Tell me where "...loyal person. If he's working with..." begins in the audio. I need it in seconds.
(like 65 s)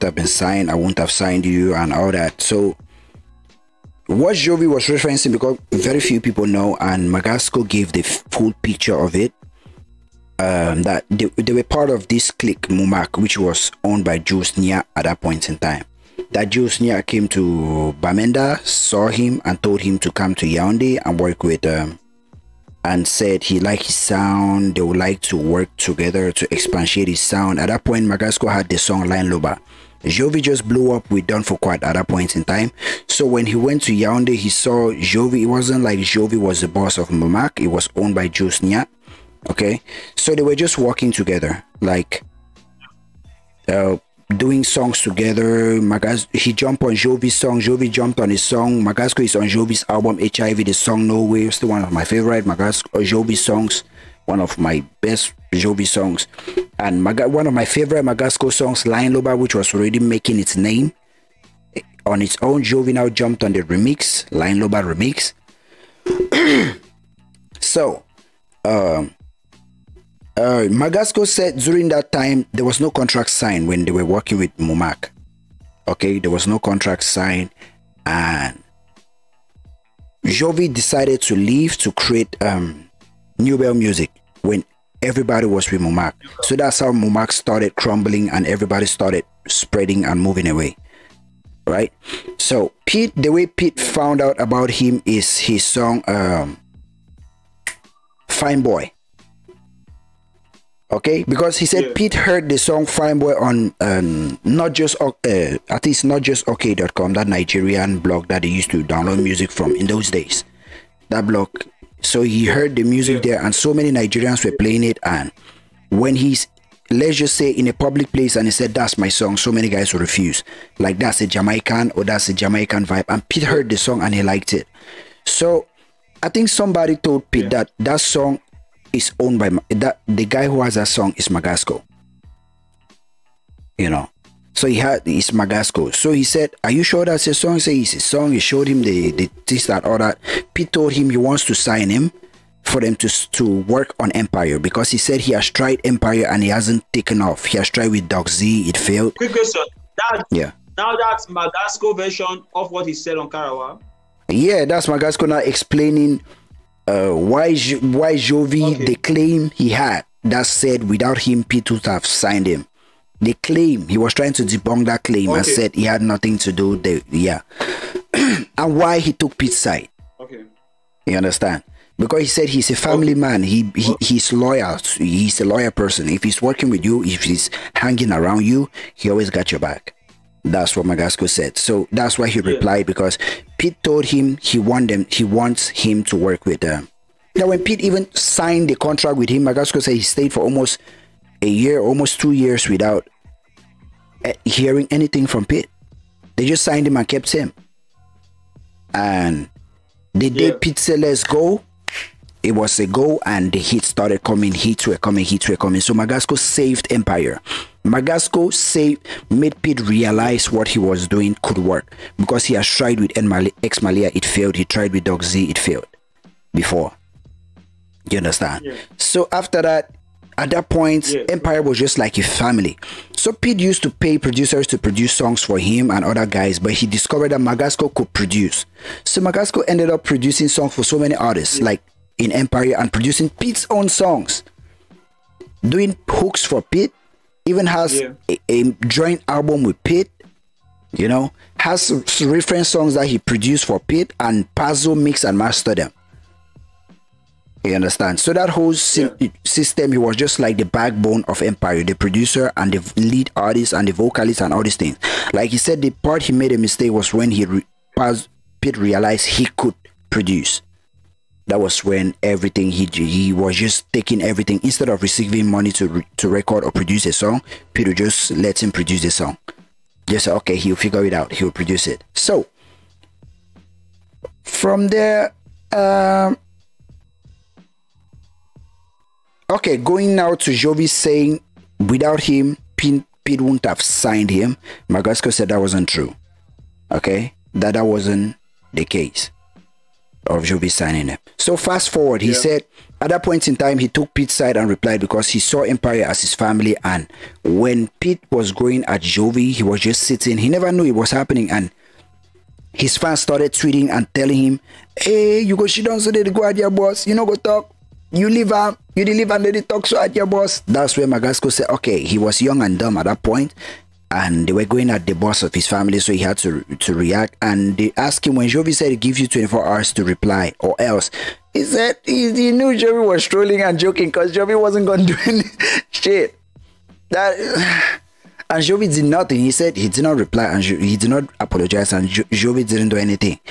175 s.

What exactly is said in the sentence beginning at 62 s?
Jovi now jumped on the remix, Lion Loba remix.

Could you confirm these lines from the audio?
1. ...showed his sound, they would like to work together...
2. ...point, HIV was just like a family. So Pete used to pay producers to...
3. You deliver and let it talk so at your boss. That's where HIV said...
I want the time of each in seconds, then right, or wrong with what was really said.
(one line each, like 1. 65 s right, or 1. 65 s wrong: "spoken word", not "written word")
1. 23 s wrong: "liked", not "showed"
2. 220 s wrong: "Empire", not "HIV"
3. 308 s wrong: "Magasco", not "HIV".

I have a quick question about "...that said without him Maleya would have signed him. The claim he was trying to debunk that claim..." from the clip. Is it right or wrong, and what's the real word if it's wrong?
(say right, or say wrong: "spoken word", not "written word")
wrong: "Pete", not "Maleya".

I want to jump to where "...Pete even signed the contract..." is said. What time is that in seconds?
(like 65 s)
187 s.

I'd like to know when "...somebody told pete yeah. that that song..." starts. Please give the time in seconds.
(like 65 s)
126 s.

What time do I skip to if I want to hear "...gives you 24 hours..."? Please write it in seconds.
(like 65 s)
318 s.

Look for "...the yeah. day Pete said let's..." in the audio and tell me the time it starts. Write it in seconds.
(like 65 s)
200 s.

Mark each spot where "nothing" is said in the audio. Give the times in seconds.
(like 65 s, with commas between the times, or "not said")
166 s, 329 s.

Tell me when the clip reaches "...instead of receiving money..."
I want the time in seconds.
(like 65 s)
264 s.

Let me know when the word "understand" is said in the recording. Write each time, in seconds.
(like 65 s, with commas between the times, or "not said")
171 s, 218 s, 247 s.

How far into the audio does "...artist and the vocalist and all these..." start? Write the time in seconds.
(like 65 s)
253 s.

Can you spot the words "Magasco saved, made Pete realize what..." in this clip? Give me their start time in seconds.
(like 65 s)
207 s.